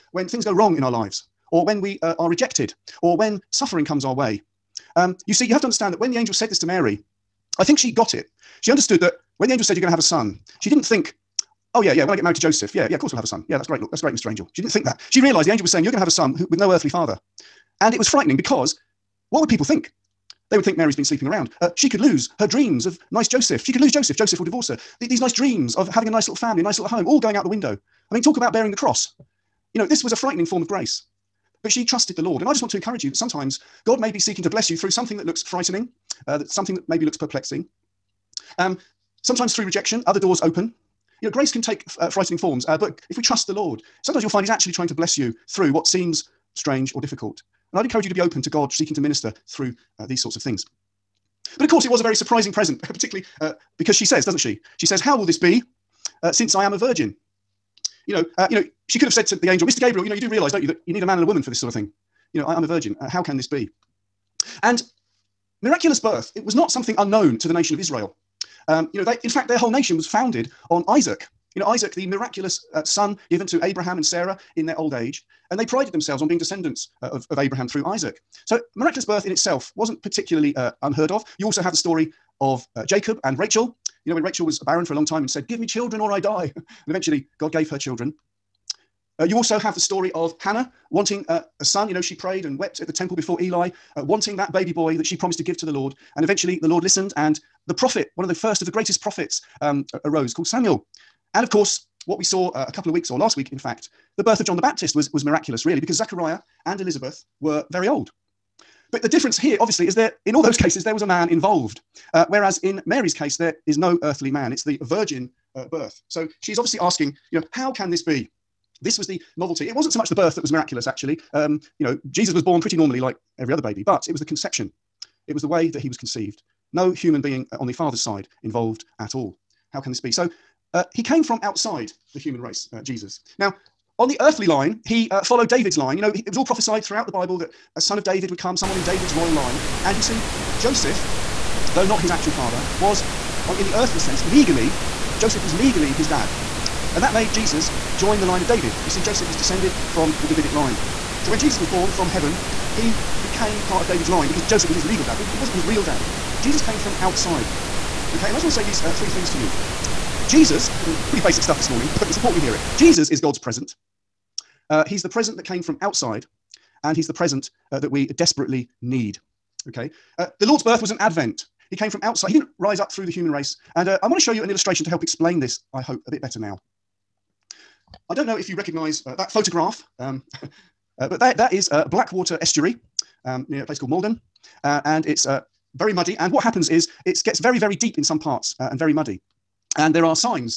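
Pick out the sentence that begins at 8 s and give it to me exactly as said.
She understood that when the angel said, You're going to have a son, she didn't think, Oh yeah, yeah.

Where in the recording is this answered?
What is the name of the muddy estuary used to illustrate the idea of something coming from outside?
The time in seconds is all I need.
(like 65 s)
181 s.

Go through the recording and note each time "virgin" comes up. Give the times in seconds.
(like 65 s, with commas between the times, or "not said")
56 s, 62 s, 114 s.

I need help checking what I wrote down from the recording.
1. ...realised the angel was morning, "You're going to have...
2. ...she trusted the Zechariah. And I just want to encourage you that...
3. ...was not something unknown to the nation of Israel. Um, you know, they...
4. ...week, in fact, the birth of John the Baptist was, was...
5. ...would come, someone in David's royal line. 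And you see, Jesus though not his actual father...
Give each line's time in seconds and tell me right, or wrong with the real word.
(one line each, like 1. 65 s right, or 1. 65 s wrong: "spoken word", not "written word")
1. 15 s wrong: "saying", not "morning"
2. 31 s wrong: "Lord", not "Zechariah"
3. 66 s right
4. 103 s right
5. 138 s wrong: "Joseph", not "Jesus".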